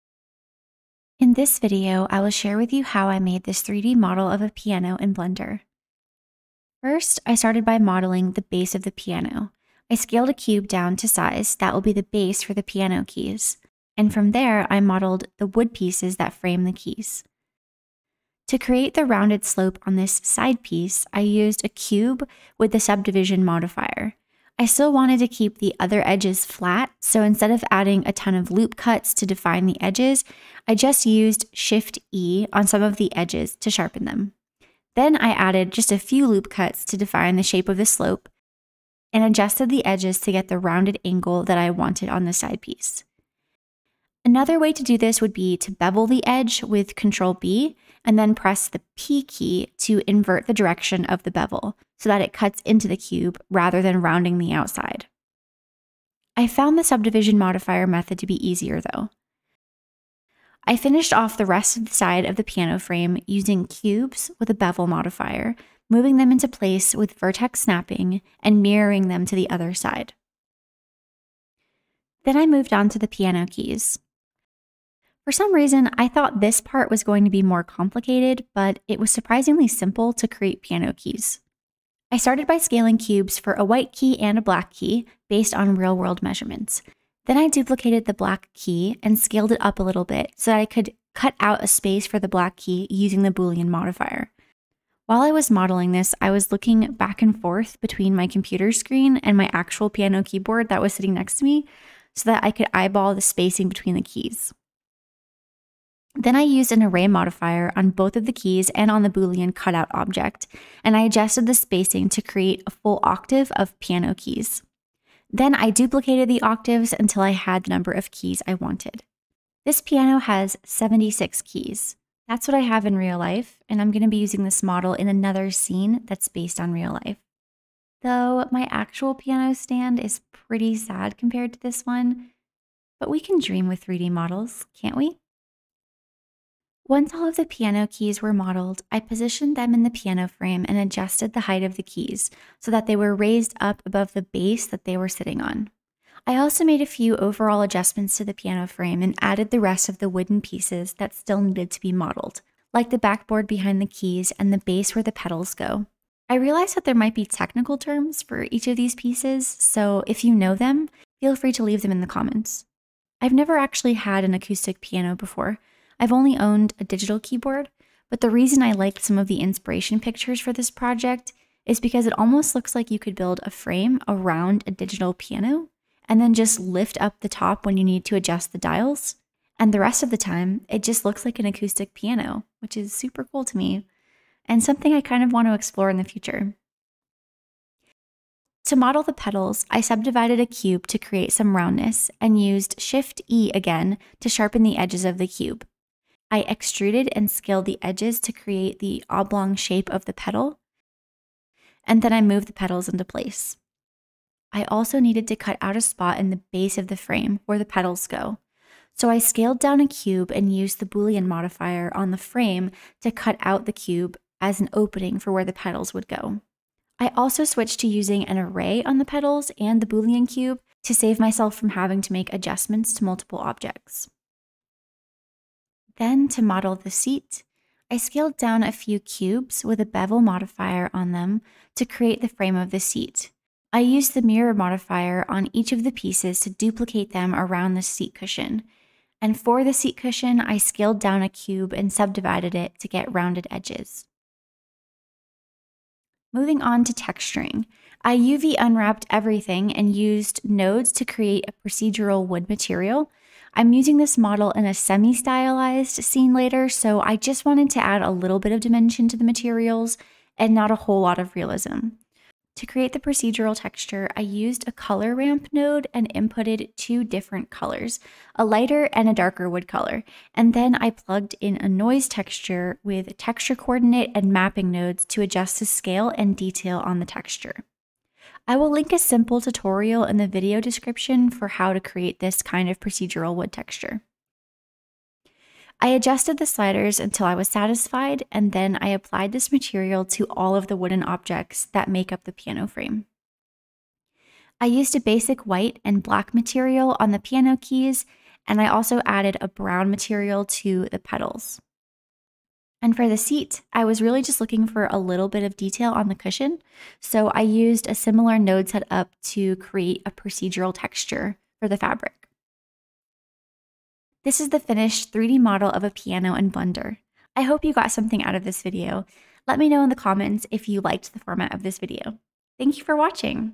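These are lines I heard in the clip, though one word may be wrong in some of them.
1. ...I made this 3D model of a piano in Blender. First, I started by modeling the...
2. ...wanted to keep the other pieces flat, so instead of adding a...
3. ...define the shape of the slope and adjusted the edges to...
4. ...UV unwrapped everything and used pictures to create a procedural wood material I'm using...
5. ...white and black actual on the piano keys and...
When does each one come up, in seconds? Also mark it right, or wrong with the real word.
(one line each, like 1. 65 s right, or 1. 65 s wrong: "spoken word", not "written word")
1. 3 s right
2. 24 s wrong: "edges", not "pieces"
3. 36 s right
4. 248 s wrong: "nodes", not "pictures"
5. 295 s wrong: "material", not "actual".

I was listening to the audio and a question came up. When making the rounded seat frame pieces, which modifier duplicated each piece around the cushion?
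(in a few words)
mirror modifier.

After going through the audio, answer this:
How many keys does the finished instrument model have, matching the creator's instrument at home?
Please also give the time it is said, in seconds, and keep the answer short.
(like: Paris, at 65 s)
76, at 120 s.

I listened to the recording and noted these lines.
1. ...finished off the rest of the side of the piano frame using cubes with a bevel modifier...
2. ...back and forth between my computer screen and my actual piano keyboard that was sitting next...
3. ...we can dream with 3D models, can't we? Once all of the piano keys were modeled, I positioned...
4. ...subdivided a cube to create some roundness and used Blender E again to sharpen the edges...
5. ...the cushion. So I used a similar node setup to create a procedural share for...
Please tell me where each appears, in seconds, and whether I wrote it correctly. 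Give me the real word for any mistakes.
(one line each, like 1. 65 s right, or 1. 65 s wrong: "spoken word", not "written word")
1. 60 s right
2. 96 s right
3. 133 s right
4. 189 s wrong: "Shift", not "Blender"
5. 306 s wrong: "texture", not "share".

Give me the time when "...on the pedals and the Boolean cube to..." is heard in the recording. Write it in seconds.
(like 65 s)
218 s.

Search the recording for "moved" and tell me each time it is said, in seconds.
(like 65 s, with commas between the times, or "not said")
72 s, 202 s.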